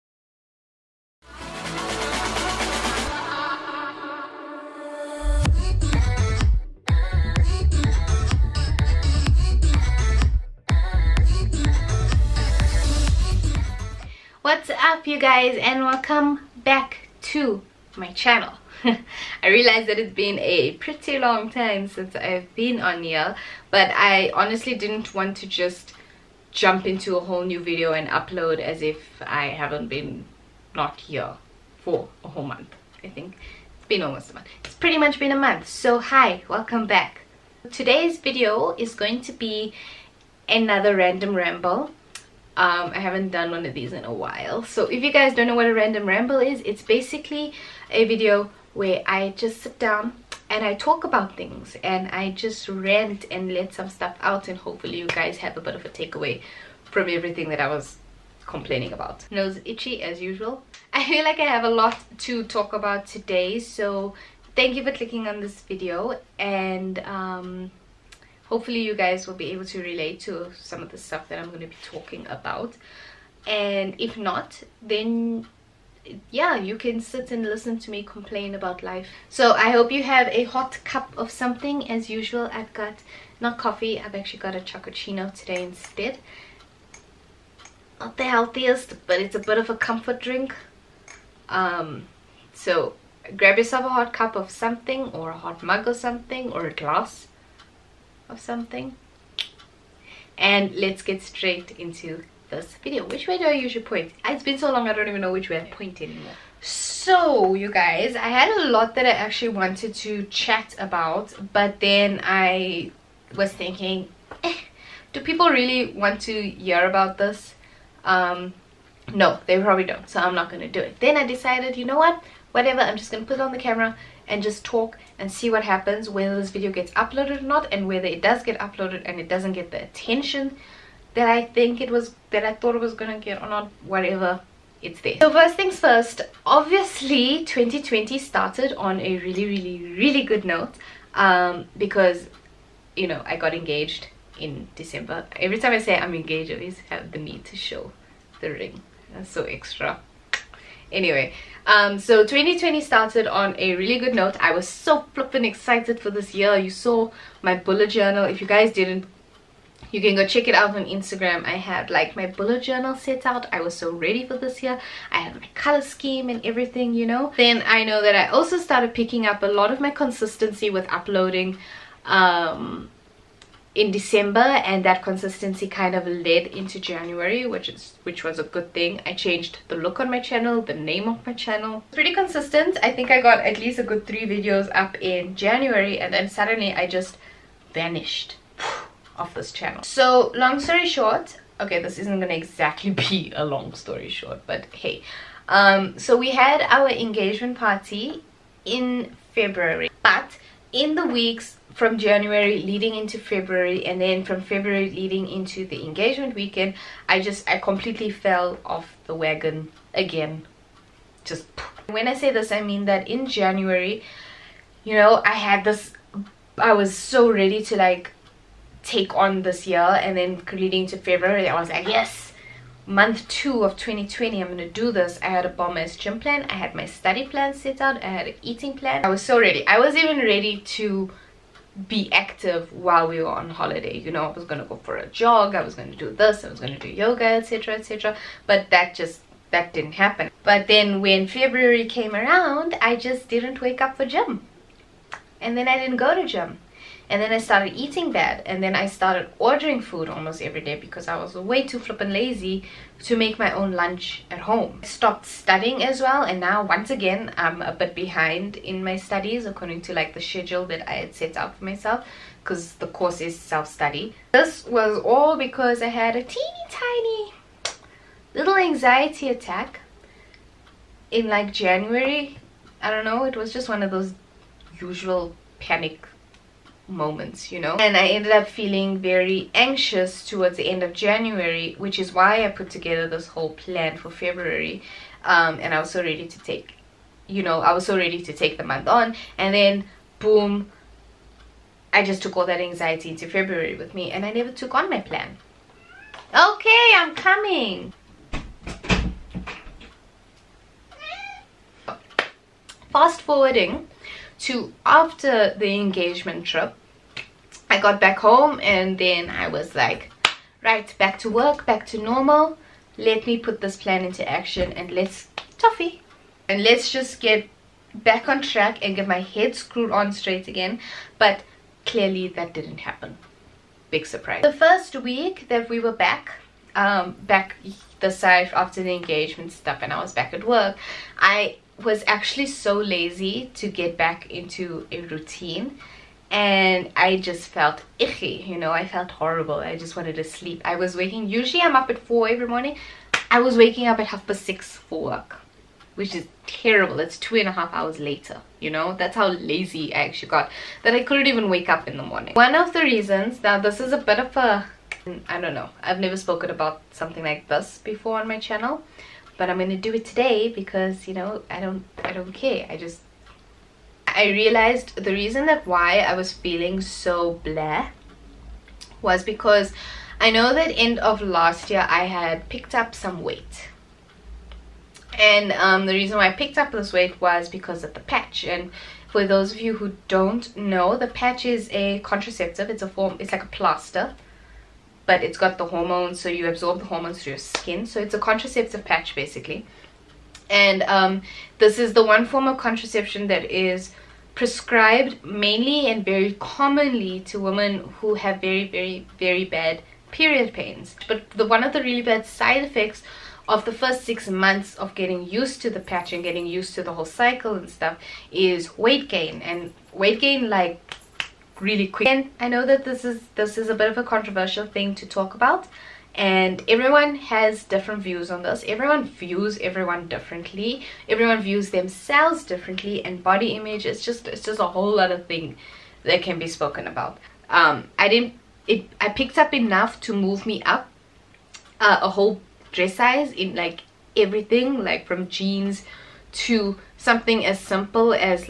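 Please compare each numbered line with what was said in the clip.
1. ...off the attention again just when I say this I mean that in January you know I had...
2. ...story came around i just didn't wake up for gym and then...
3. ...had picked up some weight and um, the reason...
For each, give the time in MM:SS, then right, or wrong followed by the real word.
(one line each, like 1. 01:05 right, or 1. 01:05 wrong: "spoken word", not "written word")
1. 03:28 wrong: "wagon", not "attention"
2. 04:01 wrong: "february", not "story"
3. 06:12 right.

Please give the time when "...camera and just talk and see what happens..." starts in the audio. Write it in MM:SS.
02:03.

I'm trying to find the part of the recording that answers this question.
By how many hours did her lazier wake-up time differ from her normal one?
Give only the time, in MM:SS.
05:47.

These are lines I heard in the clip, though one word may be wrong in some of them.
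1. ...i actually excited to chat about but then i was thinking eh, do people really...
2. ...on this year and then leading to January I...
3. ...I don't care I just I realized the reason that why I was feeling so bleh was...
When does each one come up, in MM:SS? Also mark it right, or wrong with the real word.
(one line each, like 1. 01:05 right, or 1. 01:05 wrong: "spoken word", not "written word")
1. 01:49 wrong: "wanted", not "excited"
2. 03:39 wrong: "February", not "January"
3. 06:02 right.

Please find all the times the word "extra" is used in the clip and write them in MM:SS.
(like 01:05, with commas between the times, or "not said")
02:29.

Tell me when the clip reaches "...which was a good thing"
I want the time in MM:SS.
02:58.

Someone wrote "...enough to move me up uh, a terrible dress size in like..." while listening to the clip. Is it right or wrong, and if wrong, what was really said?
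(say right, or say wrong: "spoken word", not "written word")
wrong: "whole", not "terrible".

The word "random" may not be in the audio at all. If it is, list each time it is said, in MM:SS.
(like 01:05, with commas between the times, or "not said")
00:40, 00:45.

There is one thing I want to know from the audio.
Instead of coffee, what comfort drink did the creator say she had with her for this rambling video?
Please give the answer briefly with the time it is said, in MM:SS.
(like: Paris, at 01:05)
chocochino, at 01:24.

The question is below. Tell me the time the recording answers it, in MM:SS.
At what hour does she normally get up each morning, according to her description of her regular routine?
05:41.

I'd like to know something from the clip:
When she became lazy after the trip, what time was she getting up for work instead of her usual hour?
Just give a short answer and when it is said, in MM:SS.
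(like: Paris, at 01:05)
half past 6, at 05:44.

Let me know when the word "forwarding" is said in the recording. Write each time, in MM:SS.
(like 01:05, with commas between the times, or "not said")
05:03.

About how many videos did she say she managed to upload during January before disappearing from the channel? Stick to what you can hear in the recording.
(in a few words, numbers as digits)
3.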